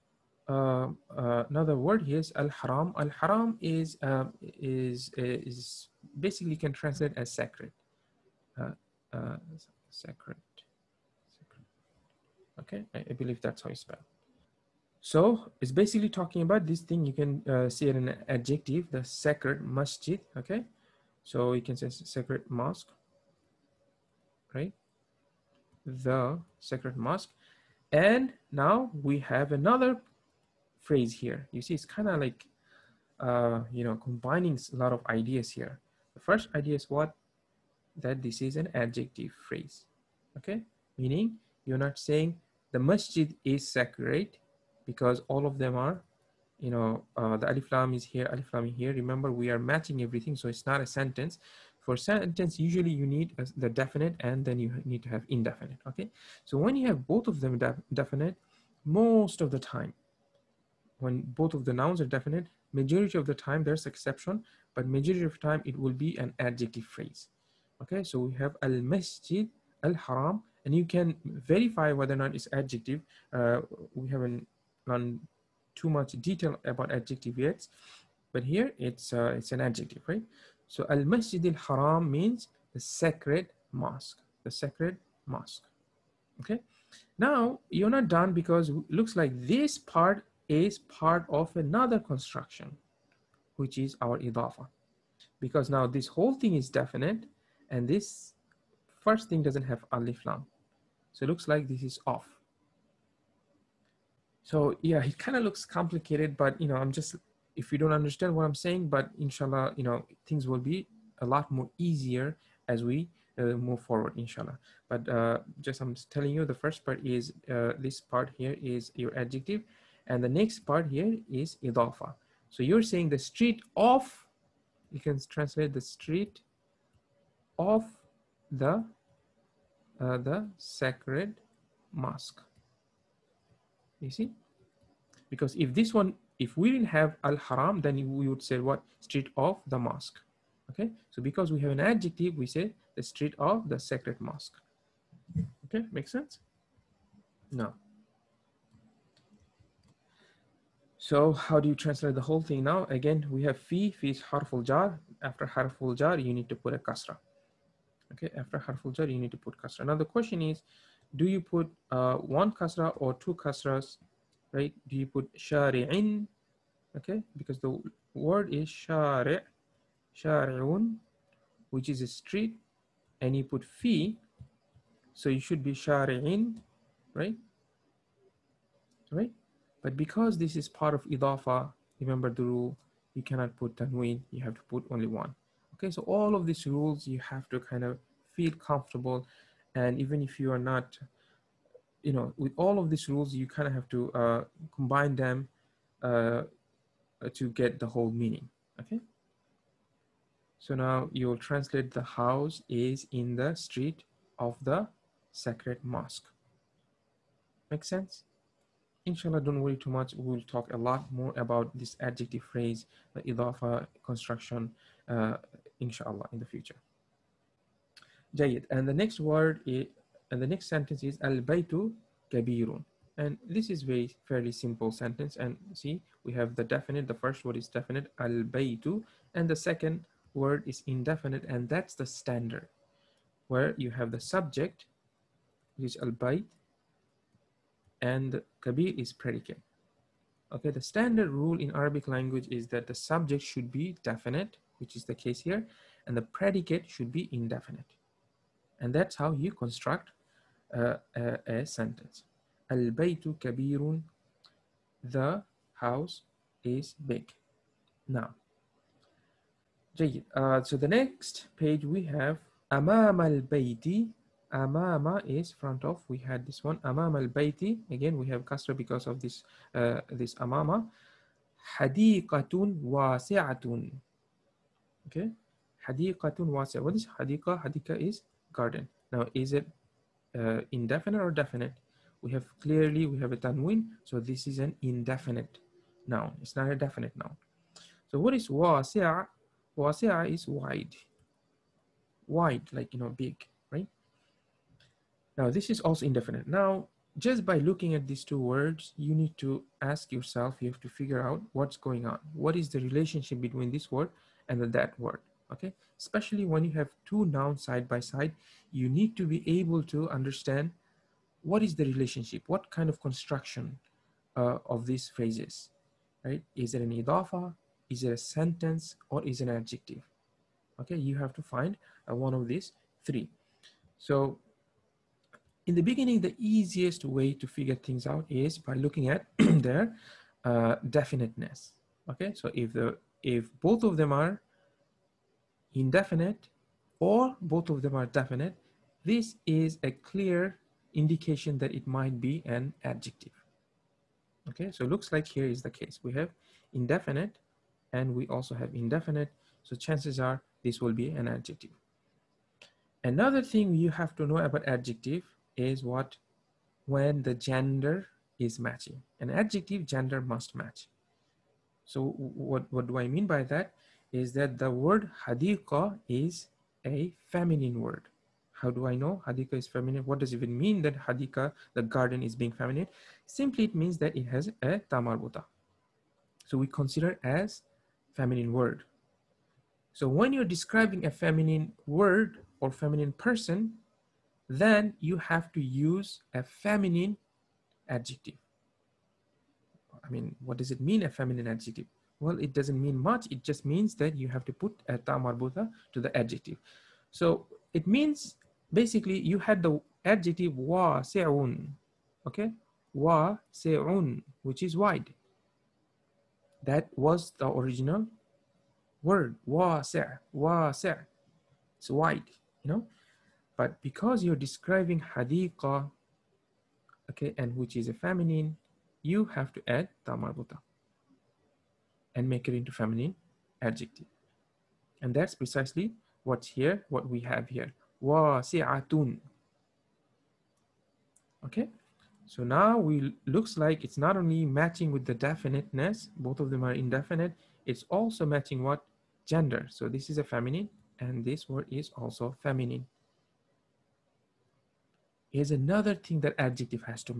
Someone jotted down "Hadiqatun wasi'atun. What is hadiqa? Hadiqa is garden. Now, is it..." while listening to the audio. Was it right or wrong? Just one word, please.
right.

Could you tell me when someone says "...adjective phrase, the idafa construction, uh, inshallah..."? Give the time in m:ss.
3:32.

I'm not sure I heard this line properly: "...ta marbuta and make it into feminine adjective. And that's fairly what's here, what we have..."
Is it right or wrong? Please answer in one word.
wrong.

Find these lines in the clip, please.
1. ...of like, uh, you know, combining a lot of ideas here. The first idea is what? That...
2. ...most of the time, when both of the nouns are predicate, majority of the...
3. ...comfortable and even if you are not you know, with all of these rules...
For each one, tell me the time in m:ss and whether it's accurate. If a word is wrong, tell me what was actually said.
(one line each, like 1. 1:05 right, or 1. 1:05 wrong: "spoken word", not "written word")
1. 0:32 right
2. 0:58 wrong: "definite", not "predicate"
3. 3:08 right.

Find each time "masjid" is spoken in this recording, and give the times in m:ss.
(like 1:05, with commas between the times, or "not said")
0:19, 0:42, 1:08, 1:20.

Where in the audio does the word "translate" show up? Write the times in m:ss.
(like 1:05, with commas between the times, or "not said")
0:06, 2:05, 2:31, 3:21.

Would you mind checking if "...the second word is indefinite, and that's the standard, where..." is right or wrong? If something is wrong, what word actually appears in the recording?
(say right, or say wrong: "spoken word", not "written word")
right.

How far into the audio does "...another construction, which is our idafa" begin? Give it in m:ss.
1:31.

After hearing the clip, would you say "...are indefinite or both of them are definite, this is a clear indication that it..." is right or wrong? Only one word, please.
right.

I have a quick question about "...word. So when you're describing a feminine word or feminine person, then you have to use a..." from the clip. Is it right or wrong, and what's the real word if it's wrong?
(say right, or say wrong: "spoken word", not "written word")
right.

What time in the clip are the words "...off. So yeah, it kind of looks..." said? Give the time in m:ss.
1:42.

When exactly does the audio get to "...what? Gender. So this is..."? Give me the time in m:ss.
7:18.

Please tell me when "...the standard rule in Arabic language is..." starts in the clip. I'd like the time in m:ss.
4:00.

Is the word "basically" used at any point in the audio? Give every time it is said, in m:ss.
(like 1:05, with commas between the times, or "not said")
0:06, 0:15, 6:38.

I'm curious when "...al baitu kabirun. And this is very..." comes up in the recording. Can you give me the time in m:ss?
3:41.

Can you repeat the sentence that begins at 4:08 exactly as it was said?
And that's how you construct a, a sentence.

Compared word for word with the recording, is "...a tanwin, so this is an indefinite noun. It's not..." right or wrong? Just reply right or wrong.
right.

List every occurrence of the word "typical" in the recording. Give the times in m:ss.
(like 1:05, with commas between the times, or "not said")
not said.